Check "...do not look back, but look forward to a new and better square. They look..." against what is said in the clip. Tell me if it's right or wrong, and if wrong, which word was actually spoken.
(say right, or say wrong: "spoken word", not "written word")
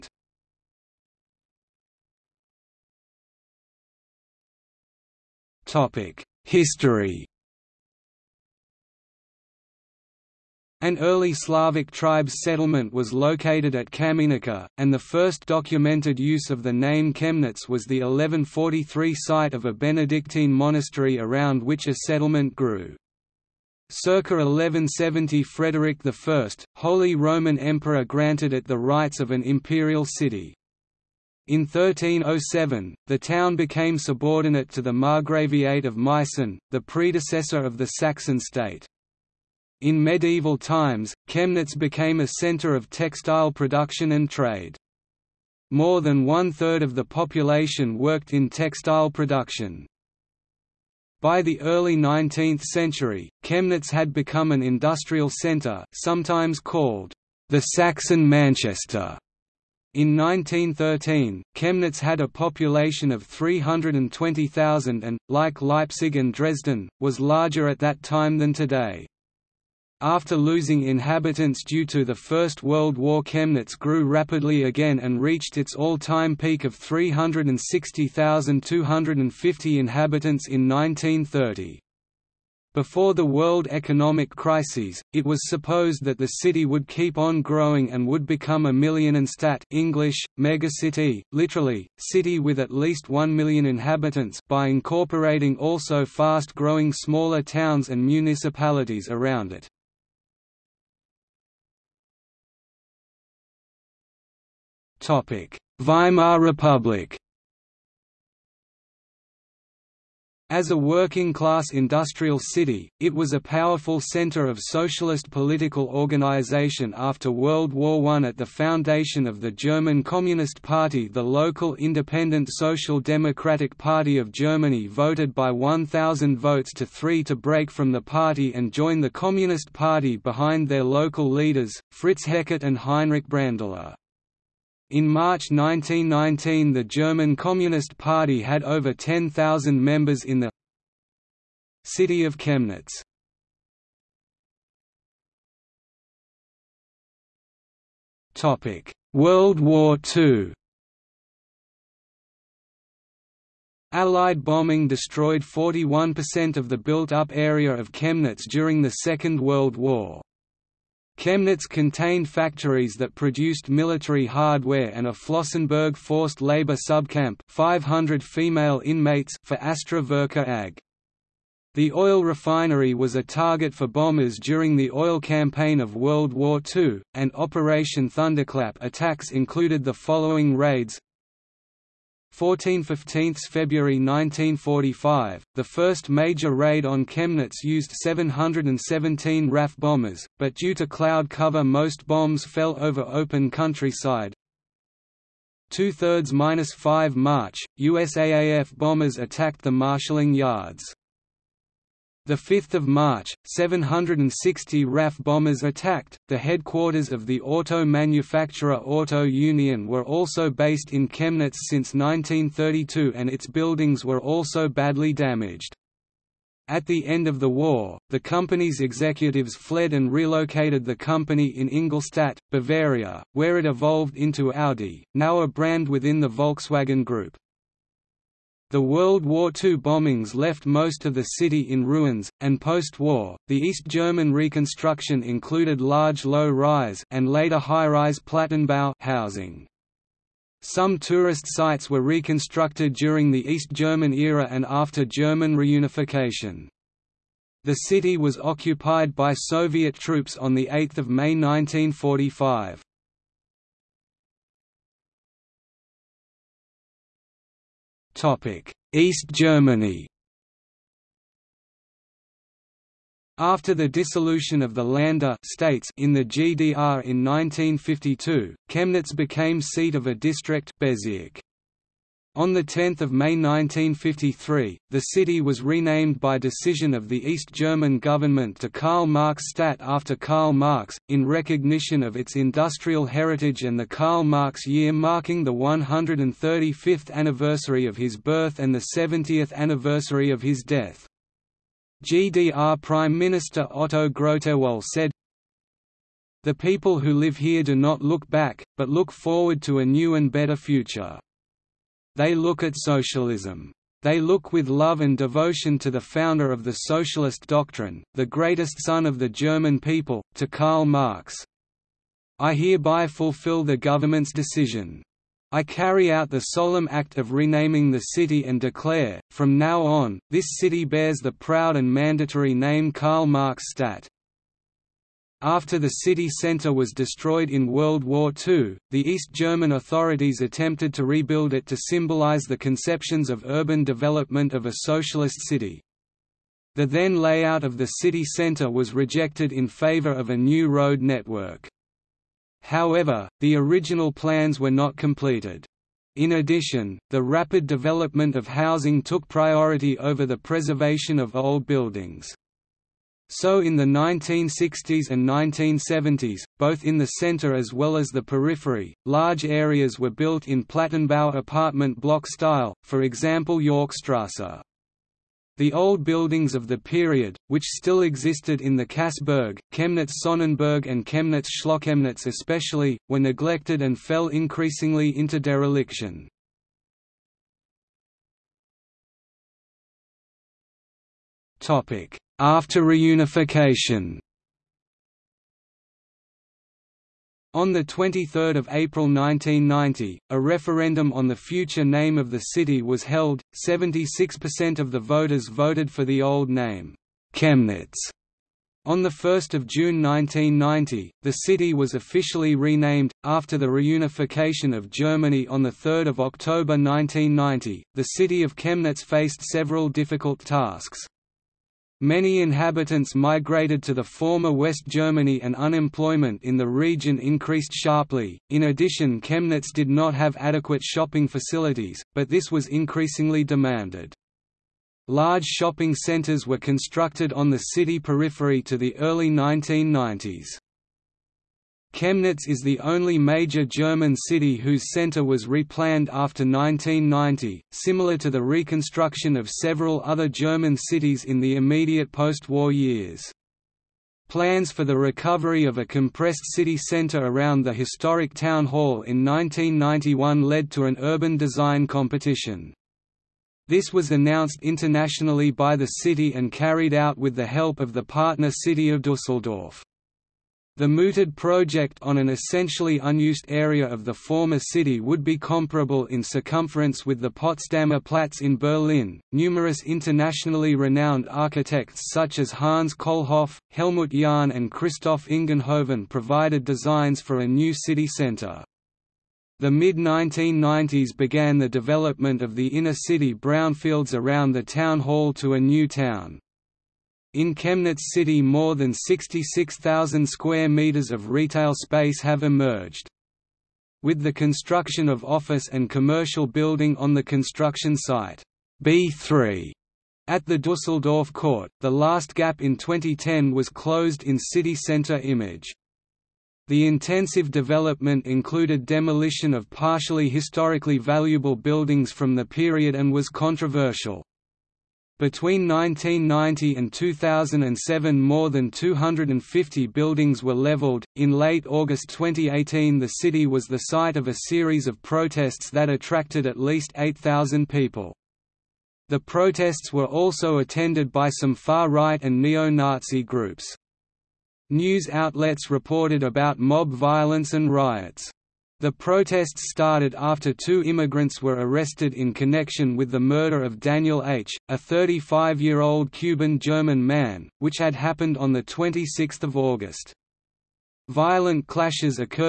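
wrong: "future", not "square".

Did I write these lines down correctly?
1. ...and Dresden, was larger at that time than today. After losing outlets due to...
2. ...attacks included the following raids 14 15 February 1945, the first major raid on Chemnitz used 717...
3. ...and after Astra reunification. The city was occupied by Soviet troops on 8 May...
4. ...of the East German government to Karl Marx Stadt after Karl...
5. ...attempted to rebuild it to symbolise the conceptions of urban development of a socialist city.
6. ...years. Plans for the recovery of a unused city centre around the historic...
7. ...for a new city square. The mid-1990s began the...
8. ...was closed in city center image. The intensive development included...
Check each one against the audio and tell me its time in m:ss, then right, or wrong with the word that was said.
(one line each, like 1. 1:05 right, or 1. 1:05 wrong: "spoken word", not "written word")
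1. 1:06 wrong: "inhabitants", not "outlets"
2. 2:58 right
3. 4:04 wrong: "German", not "Astra"
4. 4:36 right
5. 5:30 right
6. 7:22 wrong: "compressed", not "unused"
7. 7:57 wrong: "centre", not "square"
8. 8:23 right.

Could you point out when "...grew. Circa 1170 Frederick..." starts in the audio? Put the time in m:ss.
0:22.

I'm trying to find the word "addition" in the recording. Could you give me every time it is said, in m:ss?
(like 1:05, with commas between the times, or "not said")
5:46, 6:58.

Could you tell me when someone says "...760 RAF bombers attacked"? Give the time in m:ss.
3:23.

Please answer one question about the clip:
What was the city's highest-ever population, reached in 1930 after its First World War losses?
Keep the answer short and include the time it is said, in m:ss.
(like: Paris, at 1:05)
360,250, at 1:16.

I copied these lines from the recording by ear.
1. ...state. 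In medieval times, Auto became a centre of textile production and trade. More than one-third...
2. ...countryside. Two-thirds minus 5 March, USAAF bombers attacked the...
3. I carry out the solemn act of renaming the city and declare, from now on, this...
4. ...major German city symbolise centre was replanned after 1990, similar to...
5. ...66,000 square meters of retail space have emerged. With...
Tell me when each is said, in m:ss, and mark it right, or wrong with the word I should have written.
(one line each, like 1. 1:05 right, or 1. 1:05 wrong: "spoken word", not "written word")
1. 0:38 wrong: "Chemnitz", not "Auto"
2. 3:13 right
3. 5:15 right
4. 7:13 wrong: "whose", not "symbolise"
5. 8:08 right.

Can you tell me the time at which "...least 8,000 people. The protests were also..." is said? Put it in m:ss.
8:46.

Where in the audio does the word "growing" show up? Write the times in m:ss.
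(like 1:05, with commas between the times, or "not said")
1:27, 1:36.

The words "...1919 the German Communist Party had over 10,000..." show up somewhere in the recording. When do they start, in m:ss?
2:15.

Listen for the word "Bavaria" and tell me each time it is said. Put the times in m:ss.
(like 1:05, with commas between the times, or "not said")
3:42.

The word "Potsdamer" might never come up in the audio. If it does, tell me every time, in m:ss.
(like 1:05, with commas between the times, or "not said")
7:47.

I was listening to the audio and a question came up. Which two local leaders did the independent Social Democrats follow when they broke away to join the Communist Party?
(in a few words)
Fritz Heckert and Heinrich Brandler.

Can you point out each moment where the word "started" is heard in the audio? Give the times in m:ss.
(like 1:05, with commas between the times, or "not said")
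8:59.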